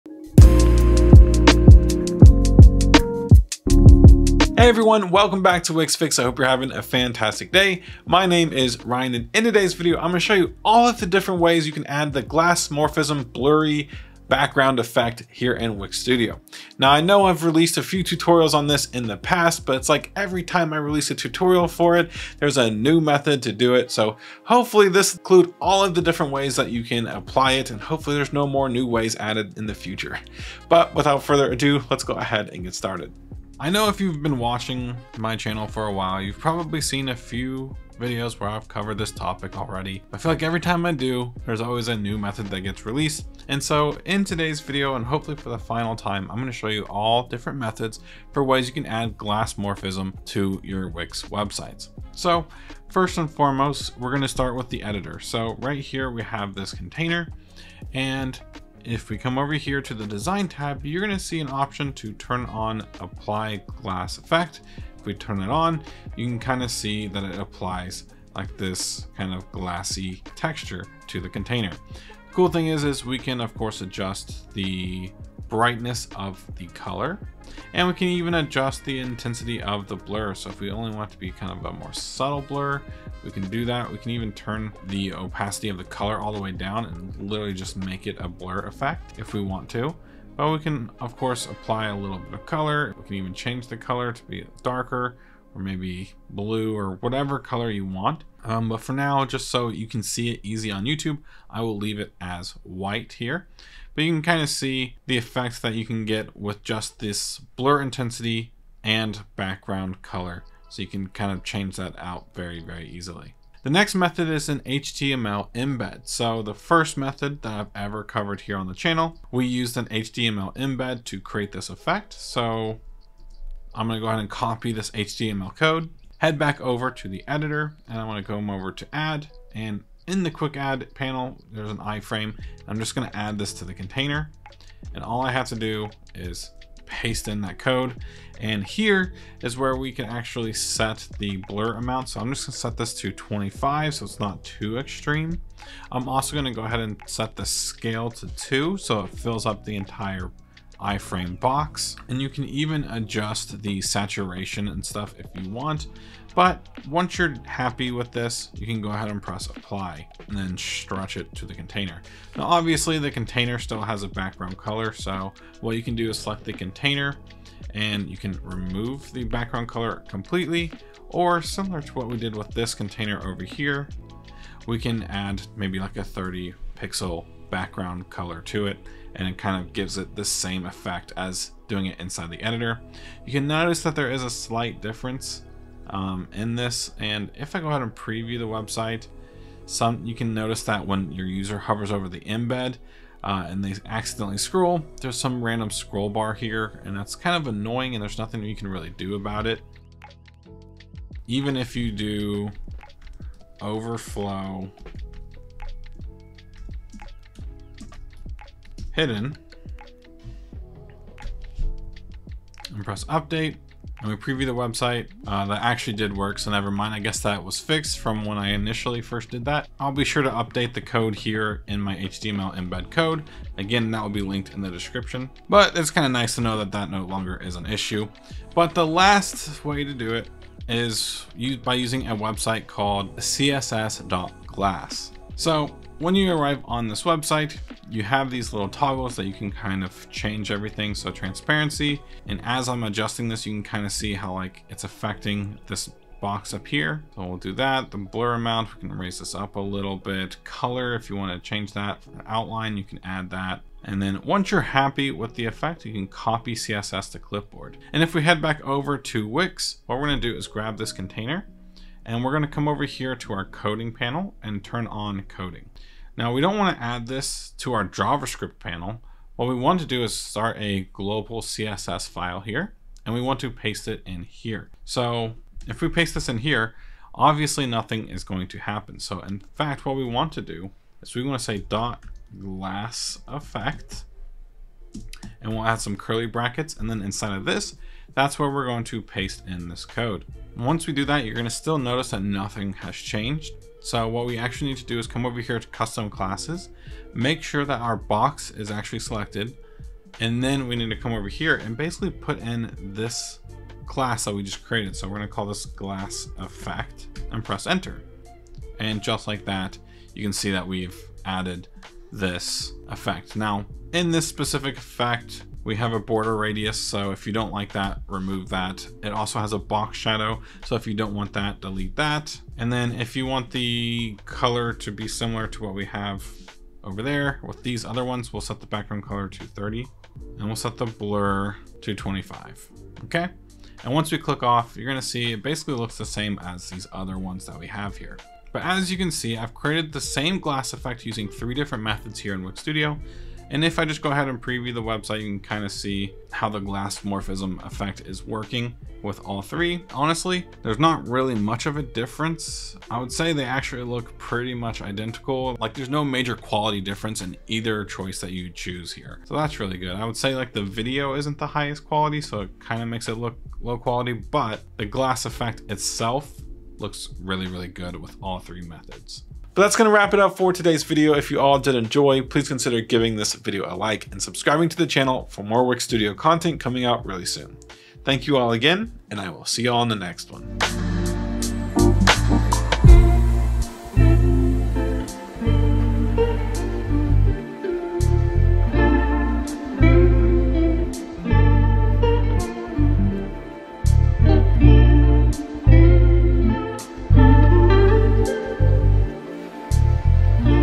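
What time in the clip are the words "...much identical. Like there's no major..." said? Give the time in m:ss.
5:54.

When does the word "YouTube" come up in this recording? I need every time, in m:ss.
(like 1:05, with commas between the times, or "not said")
1:40.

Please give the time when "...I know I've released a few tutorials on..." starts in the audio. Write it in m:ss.
0:16.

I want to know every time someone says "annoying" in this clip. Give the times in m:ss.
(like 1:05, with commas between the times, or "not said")
3:17.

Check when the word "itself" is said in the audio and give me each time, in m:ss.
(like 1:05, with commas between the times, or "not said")
6:05.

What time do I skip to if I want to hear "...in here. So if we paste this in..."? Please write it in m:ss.
4:34.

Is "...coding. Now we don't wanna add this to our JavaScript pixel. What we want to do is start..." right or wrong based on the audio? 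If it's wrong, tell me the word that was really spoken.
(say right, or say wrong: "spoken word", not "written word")
wrong: "panel", not "pixel".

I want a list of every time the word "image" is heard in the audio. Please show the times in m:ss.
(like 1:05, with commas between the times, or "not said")
not said.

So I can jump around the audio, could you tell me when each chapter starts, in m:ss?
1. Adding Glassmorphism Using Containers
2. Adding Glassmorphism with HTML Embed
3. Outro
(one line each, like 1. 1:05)
1. 0:52
2. 1:53
3. 6:09.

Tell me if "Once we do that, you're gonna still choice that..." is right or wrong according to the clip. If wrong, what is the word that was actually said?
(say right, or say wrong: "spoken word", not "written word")
wrong: "notice", not "choice".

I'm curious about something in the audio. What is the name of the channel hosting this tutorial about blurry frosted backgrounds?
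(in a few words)
Wix Fix.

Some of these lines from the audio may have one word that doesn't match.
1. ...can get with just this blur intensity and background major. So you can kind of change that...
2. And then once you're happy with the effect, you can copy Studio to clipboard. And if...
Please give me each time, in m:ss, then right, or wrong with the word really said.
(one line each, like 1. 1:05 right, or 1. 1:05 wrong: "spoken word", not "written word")
1. 1:45 wrong: "color", not "major"
2. 4:13 wrong: "CSS", not "Studio".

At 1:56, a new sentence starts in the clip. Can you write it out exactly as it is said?
So the first method that I've ever covered here on the channel, we used an HTML embed to create this effect.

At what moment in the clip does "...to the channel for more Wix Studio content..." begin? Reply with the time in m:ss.
6:14.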